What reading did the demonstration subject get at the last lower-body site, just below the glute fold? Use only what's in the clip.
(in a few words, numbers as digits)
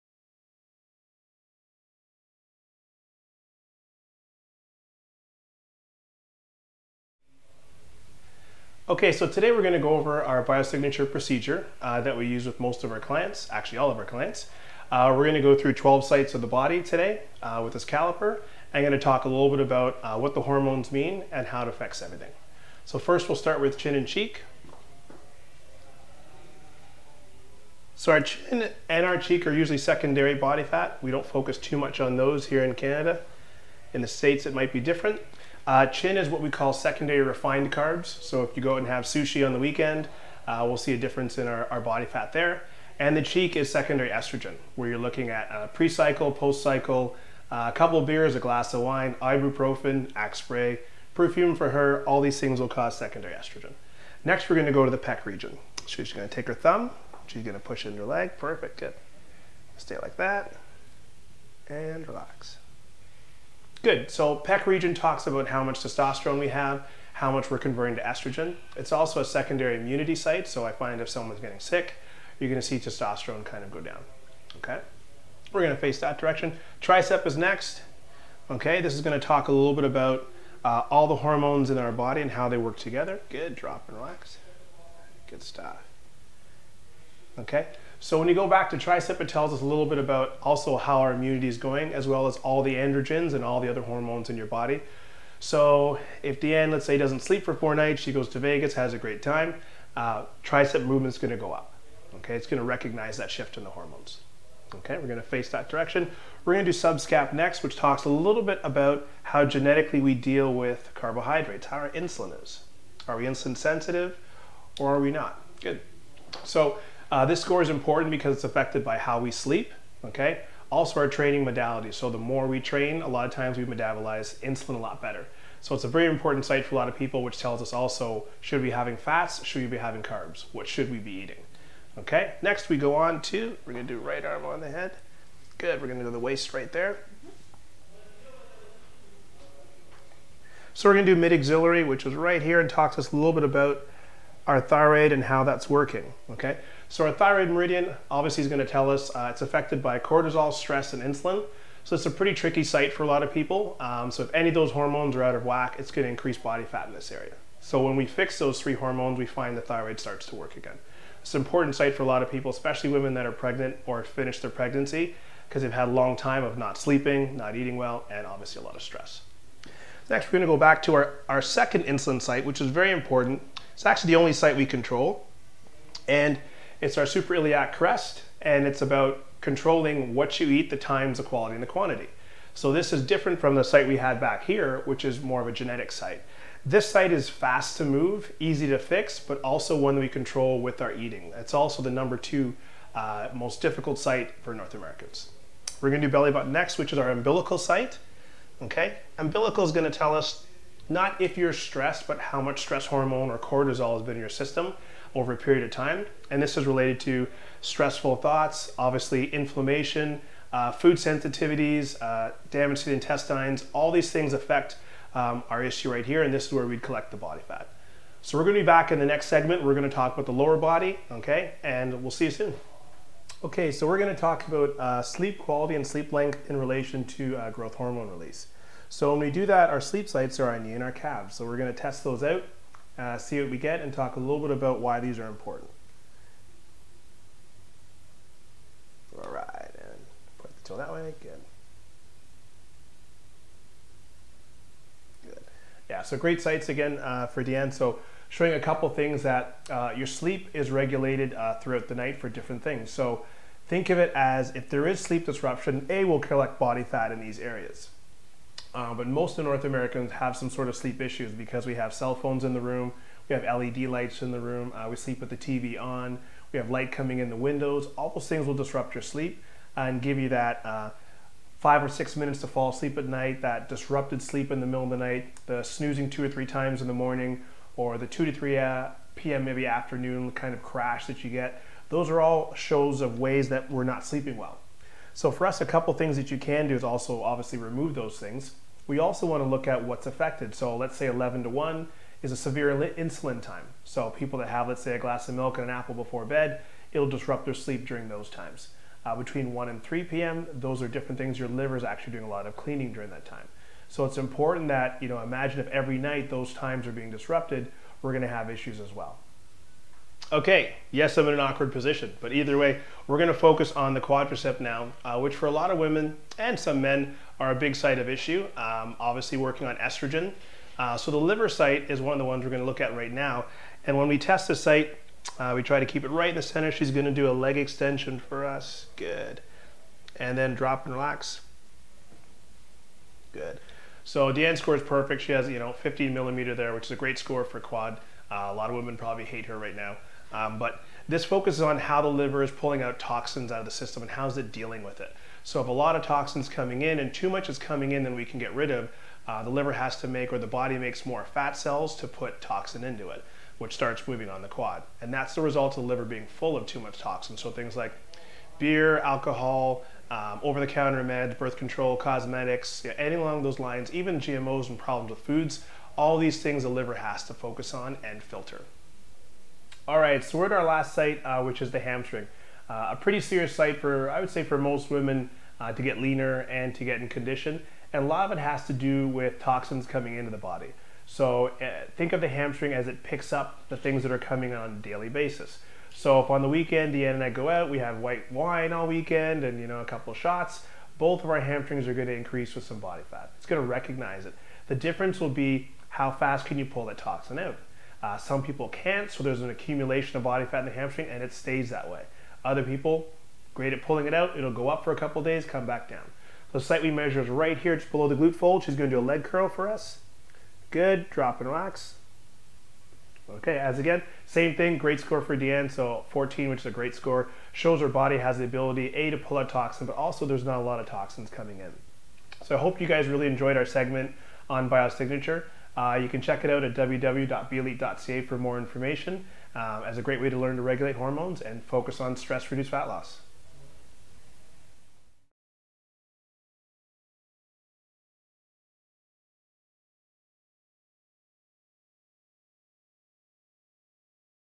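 14.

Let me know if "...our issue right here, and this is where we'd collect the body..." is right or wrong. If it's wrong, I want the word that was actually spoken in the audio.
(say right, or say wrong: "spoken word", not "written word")
right.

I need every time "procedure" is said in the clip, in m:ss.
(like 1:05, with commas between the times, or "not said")
0:11.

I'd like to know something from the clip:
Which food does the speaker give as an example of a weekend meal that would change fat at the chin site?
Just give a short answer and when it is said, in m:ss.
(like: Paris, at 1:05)
Sushi, at 0:39.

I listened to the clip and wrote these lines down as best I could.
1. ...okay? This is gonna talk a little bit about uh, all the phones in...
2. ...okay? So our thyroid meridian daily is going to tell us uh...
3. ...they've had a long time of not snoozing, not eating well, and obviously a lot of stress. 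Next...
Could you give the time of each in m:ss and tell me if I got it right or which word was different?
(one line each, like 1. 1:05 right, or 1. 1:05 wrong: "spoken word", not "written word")
1. 1:18 wrong: "hormones", not "phones"
2. 2:26 wrong: "obviously", not "daily"
3. 2:45 wrong: "sleeping", not "snoozing".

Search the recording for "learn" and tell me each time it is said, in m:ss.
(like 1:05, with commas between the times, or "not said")
7:10.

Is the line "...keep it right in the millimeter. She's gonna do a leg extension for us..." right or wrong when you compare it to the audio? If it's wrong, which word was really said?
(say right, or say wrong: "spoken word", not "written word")
wrong: "center", not "millimeter".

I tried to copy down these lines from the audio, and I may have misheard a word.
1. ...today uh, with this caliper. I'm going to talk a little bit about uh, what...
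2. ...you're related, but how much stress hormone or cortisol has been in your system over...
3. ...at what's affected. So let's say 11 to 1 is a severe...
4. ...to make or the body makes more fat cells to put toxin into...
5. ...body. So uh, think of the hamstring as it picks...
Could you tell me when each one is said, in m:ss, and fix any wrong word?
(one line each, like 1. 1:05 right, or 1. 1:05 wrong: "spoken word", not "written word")
1. 0:16 right
2. 3:21 wrong: "stressed", not "related"
3. 4:49 right
4. 5:50 right
5. 6:20 right.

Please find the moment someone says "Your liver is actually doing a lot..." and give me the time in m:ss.
5:01.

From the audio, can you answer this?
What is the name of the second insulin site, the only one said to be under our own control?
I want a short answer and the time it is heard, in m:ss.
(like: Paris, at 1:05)
Iliac crest, at 2:57.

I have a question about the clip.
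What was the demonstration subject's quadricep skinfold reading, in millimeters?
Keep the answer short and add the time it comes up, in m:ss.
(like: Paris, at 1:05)
15, at 5:35.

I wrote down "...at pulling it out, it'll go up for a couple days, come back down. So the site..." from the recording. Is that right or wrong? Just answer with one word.
right.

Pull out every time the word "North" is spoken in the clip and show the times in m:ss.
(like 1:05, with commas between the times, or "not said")
3:14, 4:19.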